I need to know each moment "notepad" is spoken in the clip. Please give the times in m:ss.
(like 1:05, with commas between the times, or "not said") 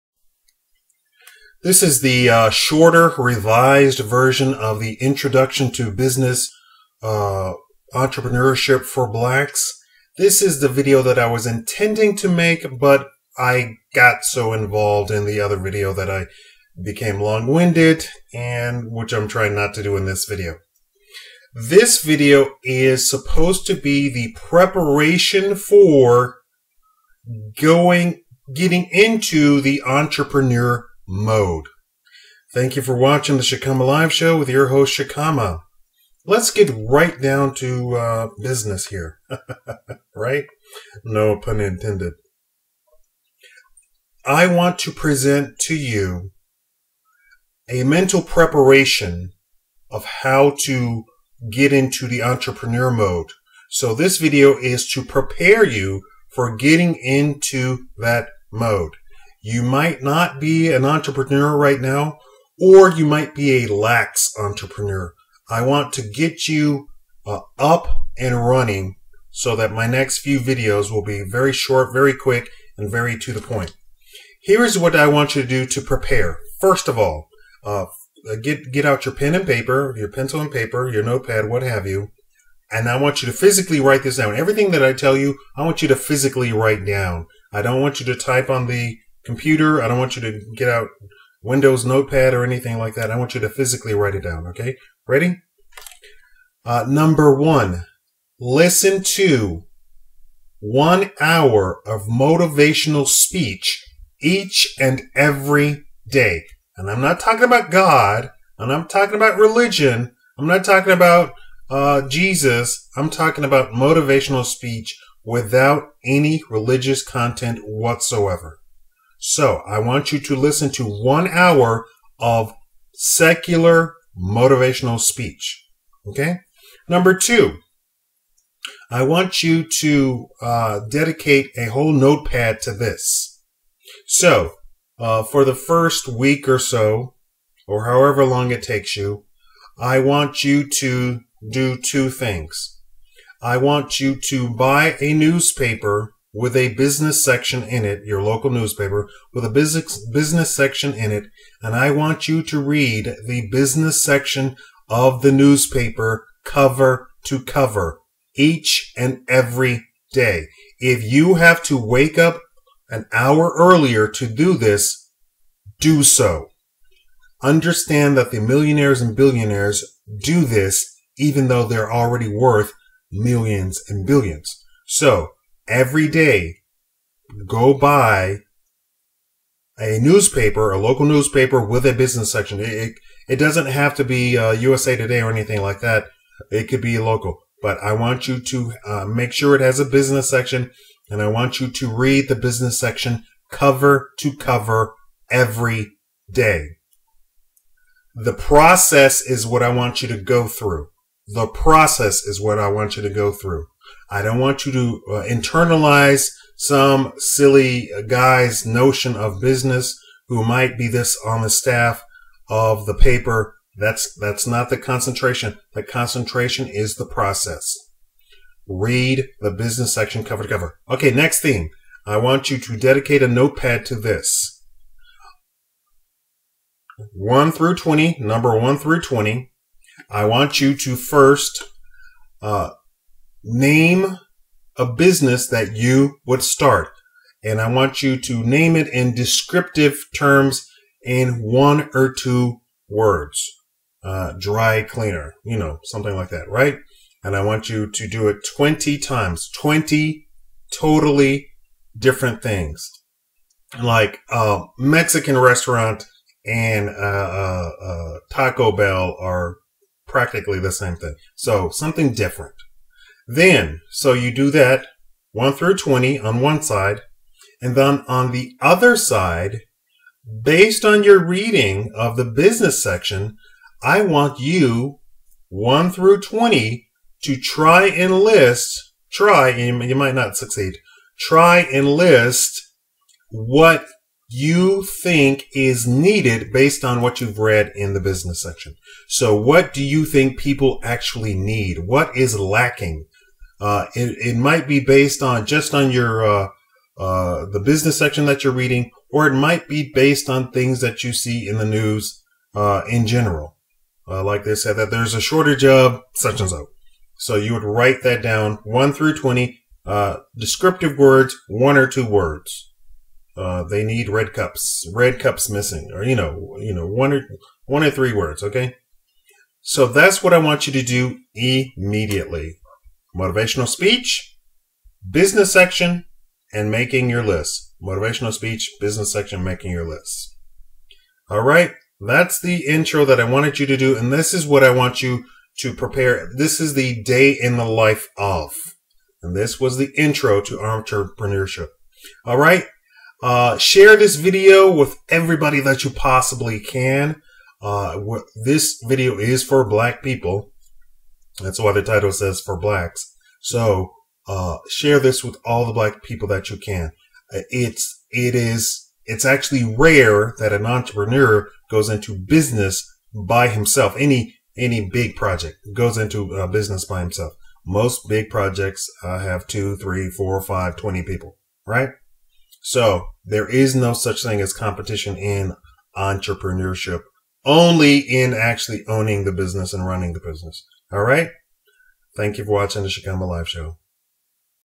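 1:21, 1:31, 2:11, 3:43.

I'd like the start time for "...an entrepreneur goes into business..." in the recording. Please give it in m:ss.
6:00.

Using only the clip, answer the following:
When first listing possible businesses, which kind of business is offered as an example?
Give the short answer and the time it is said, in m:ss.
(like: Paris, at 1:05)
dry cleaner, at 4:04.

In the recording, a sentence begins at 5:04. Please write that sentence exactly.
Uh, like they said that there's a shortage of such and so.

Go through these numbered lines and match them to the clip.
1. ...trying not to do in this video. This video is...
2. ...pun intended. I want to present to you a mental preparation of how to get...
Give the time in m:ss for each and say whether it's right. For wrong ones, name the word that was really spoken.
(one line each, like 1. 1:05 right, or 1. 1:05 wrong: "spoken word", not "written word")
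1. 0:19 right
2. 0:41 right.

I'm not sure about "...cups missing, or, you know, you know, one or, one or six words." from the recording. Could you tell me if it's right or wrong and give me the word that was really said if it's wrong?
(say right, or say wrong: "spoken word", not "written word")
wrong: "three", not "six".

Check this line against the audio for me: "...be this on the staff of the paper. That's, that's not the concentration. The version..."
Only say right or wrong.
wrong.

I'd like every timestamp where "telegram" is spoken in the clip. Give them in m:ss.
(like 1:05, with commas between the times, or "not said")
not said.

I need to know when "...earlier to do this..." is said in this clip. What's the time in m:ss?
2:43.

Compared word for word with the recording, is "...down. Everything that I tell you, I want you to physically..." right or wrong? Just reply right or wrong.
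right.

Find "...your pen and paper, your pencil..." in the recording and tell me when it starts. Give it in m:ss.
1:19.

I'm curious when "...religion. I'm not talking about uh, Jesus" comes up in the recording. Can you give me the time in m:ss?
1:49.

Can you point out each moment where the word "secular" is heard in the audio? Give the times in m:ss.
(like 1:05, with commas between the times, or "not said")
2:02.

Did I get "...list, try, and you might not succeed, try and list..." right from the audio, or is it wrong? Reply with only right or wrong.
right.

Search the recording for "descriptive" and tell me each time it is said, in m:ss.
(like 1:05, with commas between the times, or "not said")
3:59, 5:10.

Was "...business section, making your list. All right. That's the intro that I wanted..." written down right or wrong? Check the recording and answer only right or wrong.
right.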